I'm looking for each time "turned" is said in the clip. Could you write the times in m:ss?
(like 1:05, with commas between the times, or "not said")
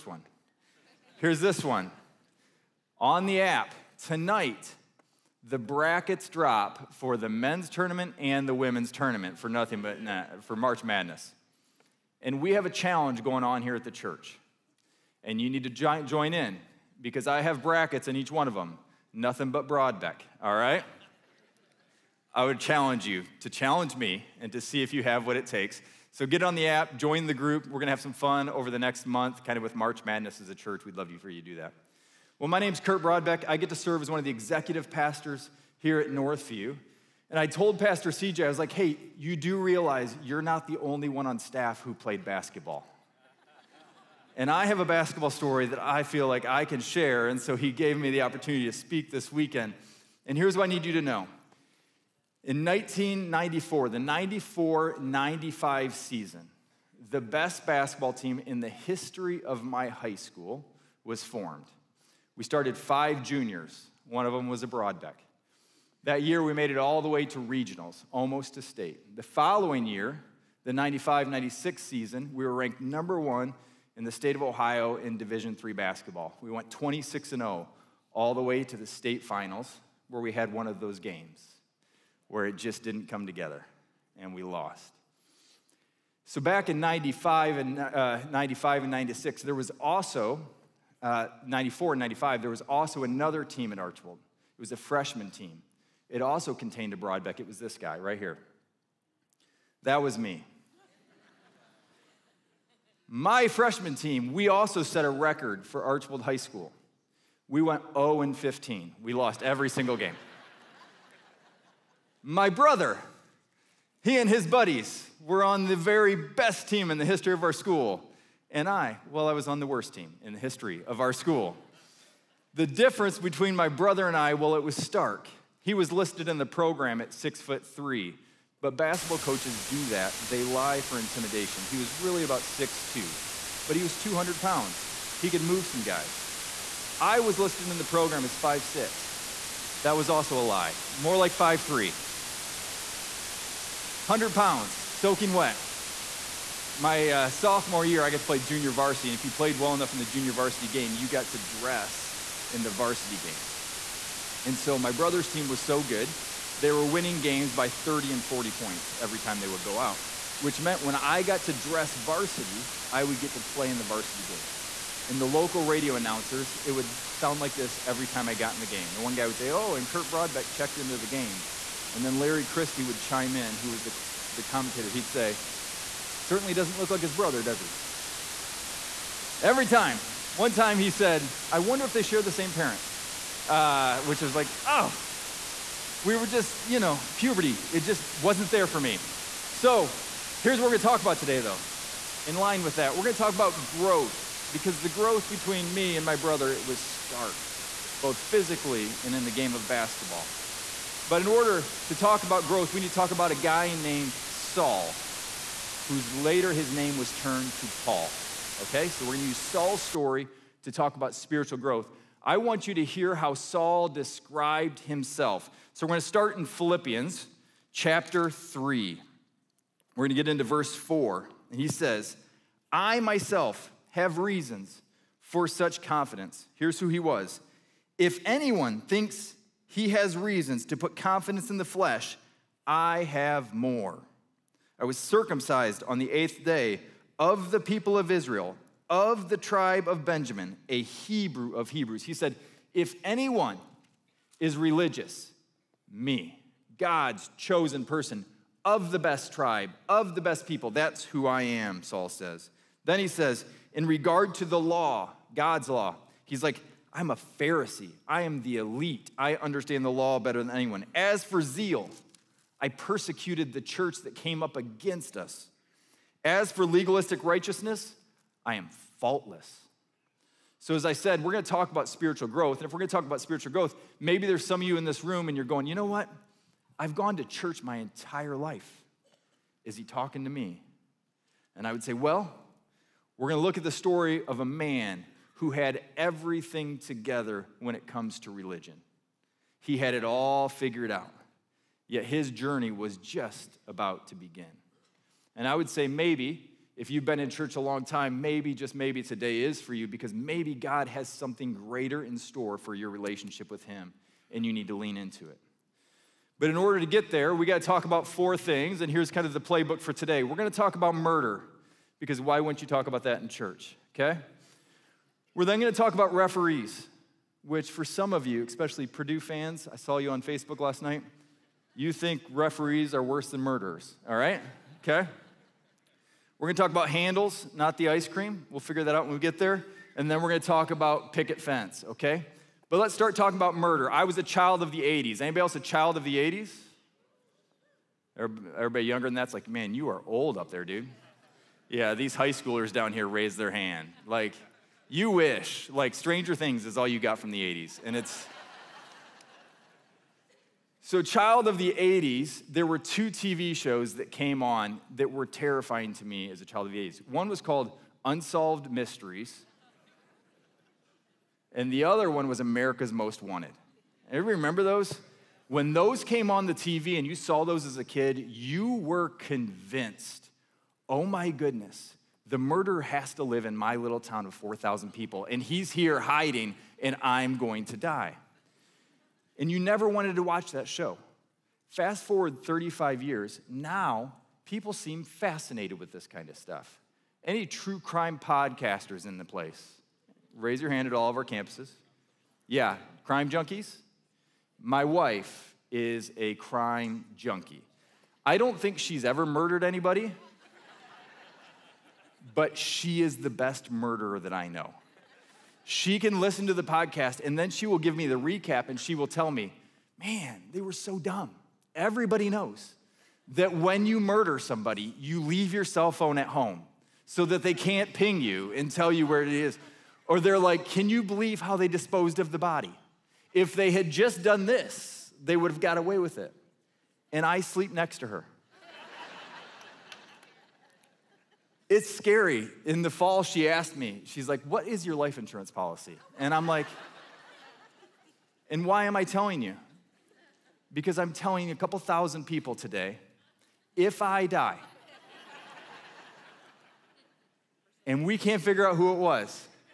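3:27.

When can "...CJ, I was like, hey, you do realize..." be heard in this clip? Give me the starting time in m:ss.
0:38.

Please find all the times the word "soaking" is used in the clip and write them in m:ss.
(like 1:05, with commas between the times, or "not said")
2:24.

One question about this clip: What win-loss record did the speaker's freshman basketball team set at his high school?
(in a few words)
0 and 15.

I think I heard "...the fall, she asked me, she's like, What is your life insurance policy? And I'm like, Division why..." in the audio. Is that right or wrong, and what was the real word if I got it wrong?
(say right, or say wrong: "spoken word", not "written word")
wrong: "And", not "Division".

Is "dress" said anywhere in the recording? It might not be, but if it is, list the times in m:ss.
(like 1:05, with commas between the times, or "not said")
2:31, 2:41.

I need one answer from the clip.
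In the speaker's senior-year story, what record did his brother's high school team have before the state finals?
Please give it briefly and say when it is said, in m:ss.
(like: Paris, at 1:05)
26-0, at 1:16.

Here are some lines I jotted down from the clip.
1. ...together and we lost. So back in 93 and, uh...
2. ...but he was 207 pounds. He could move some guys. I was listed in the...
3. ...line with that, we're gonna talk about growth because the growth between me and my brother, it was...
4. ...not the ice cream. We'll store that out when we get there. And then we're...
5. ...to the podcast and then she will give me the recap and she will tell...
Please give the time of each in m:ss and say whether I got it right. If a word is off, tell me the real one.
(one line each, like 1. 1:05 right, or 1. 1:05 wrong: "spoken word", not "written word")
1. 1:23 wrong: "95", not "93"
2. 2:13 wrong: "200", not "207"
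3. 3:12 right
4. 5:27 wrong: "figure", not "store"
5. 6:46 right.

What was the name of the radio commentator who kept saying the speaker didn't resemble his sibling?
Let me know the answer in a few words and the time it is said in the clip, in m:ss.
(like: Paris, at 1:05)
Larry Christie, at 2:52.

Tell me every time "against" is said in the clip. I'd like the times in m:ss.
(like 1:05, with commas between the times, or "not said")
4:24.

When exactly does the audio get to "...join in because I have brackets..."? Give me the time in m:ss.
0:16.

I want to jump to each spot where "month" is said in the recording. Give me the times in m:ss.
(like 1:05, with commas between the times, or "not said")
0:29.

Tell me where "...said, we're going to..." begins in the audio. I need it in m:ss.
4:30.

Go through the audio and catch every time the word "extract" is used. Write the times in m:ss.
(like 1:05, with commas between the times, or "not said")
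not said.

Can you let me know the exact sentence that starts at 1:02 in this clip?
We started five juniors, one of them was a Brodbeck.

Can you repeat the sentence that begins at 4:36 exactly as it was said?
I've gone to church my entire life.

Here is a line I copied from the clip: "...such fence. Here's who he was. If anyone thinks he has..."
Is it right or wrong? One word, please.
wrong.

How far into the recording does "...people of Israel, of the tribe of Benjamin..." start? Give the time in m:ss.
3:57.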